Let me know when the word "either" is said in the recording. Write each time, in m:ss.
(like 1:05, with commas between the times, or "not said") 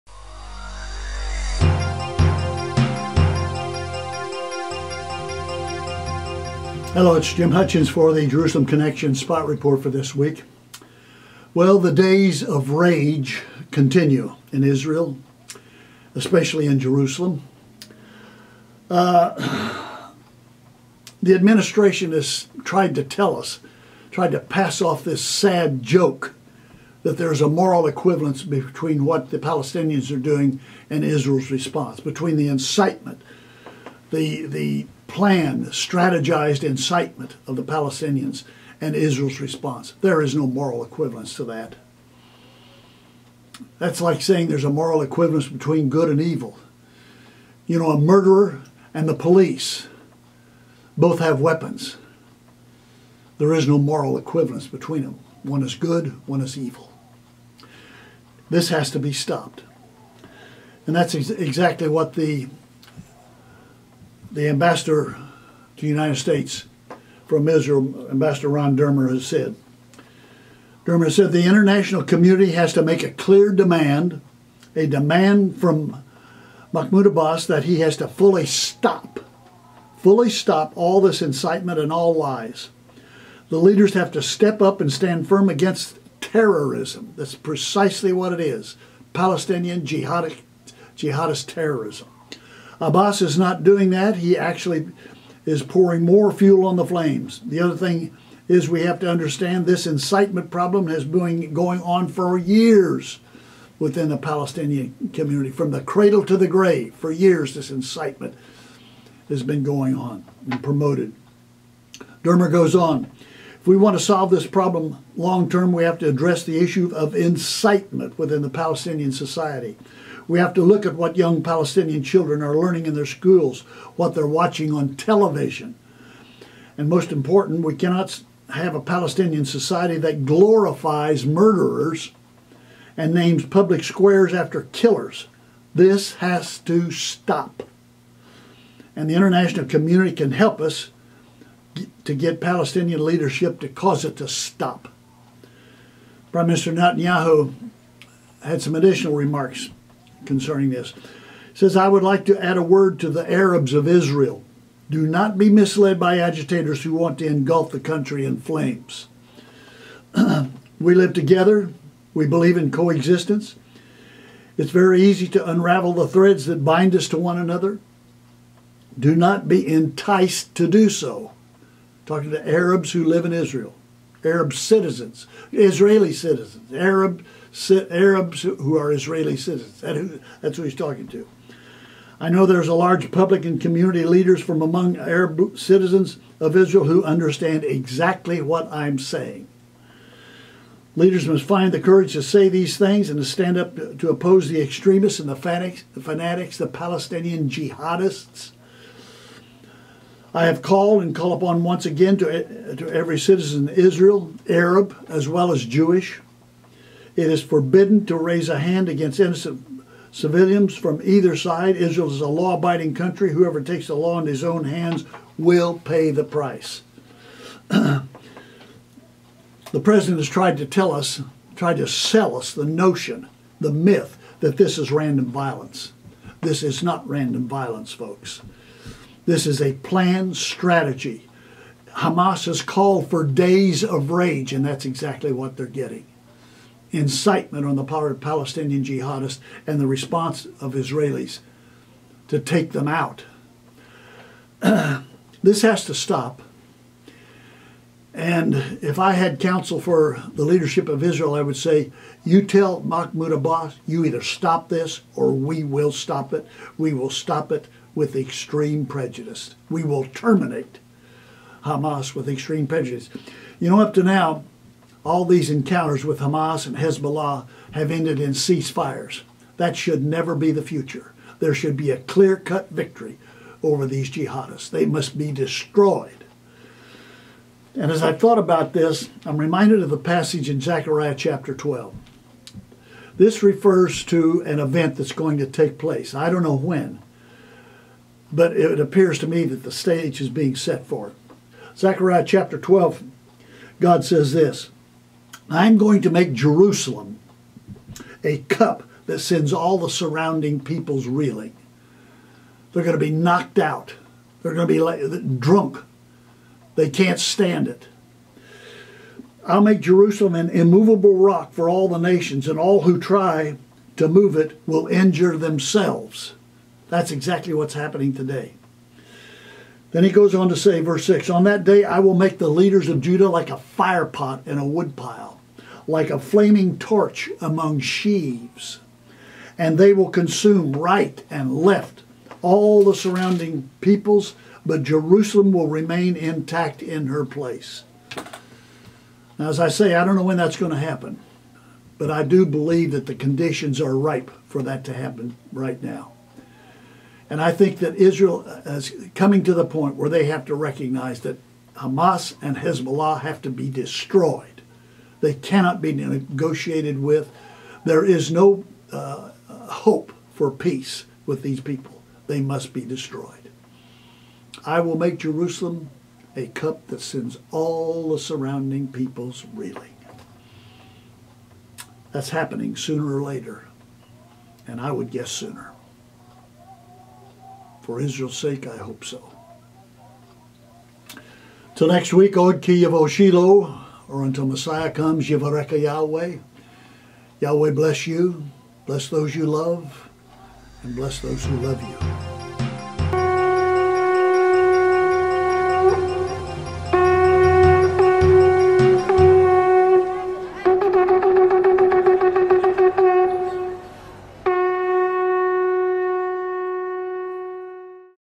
3:31, 4:14.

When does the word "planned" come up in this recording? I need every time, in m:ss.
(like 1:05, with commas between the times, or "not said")
0:35, 3:49.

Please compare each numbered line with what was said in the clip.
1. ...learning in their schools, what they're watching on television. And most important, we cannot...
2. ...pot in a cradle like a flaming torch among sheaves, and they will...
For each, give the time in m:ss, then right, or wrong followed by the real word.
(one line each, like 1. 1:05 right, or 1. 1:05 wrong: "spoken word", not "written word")
1. 2:02 right
2. 5:24 wrong: "woodpile", not "cradle".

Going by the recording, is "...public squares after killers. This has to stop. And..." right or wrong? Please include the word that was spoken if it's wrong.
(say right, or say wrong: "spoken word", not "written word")
right.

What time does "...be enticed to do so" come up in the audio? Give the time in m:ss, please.
2:49.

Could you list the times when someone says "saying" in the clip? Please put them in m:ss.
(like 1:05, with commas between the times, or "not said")
0:44, 3:08.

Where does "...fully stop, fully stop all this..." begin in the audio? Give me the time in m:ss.
1:18.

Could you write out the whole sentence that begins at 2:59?
That who, that's who he's talking to.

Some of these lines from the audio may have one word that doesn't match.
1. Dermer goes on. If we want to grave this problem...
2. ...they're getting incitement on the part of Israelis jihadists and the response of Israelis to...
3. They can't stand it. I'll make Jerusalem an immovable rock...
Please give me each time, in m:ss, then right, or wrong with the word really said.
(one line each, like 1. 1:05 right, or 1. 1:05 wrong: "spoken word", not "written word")
1. 1:52 wrong: "solve", not "grave"
2. 3:55 wrong: "Palestinian", not "Israelis"
3. 5:06 right.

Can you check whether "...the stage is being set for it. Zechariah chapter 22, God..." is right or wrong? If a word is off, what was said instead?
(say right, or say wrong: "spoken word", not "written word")
wrong: "12", not "22".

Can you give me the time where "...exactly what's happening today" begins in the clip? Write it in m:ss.
5:17.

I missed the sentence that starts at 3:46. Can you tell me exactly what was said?
This is not random violence, folks.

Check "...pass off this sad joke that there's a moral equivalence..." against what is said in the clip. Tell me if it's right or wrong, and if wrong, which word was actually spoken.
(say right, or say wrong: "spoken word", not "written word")
right.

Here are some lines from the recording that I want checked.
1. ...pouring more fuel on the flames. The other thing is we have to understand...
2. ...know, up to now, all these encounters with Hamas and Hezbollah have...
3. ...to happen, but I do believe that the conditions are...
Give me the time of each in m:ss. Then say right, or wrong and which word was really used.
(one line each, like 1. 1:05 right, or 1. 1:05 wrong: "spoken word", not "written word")
1. 1:35 right
2. 4:23 right
3. 5:40 right.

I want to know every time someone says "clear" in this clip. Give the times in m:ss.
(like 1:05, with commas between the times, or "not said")
1:13, 4:31.